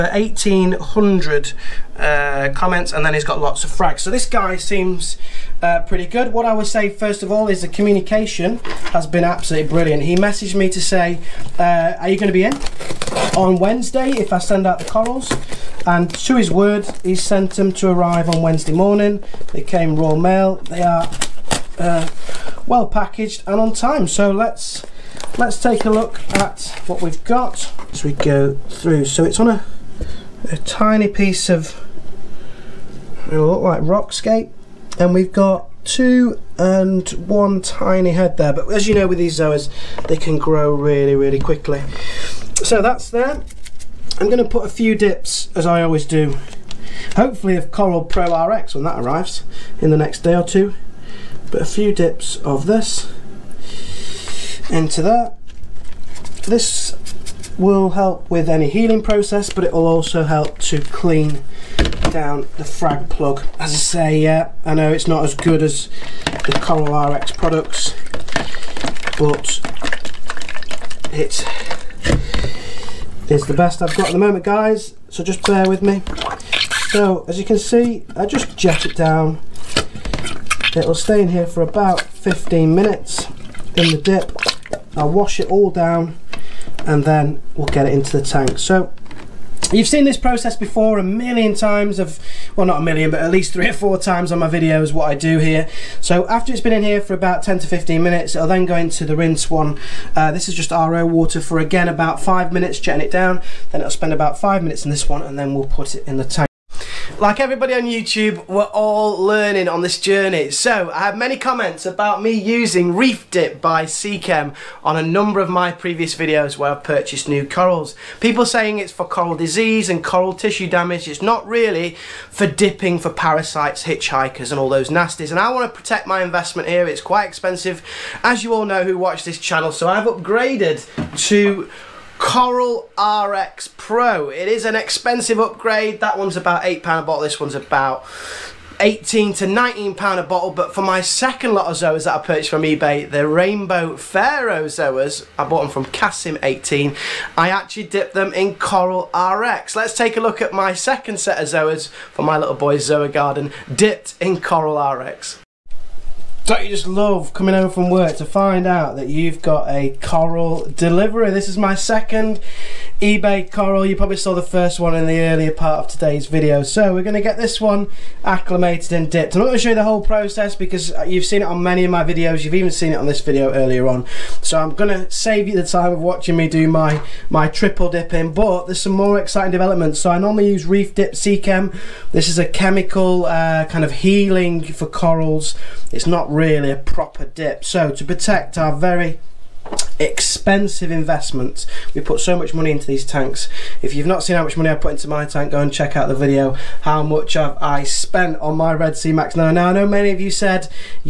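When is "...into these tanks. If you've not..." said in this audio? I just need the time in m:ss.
3:12.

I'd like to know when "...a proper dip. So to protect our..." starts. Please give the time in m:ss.
3:06.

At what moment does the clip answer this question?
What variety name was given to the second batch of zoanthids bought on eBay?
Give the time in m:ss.
2:23.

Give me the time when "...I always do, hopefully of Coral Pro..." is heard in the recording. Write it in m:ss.
0:45.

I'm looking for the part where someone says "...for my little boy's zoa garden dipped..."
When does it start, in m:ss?
2:31.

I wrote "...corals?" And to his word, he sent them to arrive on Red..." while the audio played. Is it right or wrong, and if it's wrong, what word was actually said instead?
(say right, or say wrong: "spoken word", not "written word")
wrong: "Wednesday", not "Red".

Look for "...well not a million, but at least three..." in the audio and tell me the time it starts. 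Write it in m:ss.
1:32.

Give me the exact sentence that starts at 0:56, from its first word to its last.
This will help with any healing process, but it will also help to clean down the frag plug.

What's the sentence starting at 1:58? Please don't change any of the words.
People saying it's for coral disease and coral tissue damage.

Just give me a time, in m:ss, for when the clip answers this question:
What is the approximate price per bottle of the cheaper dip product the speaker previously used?
2:16.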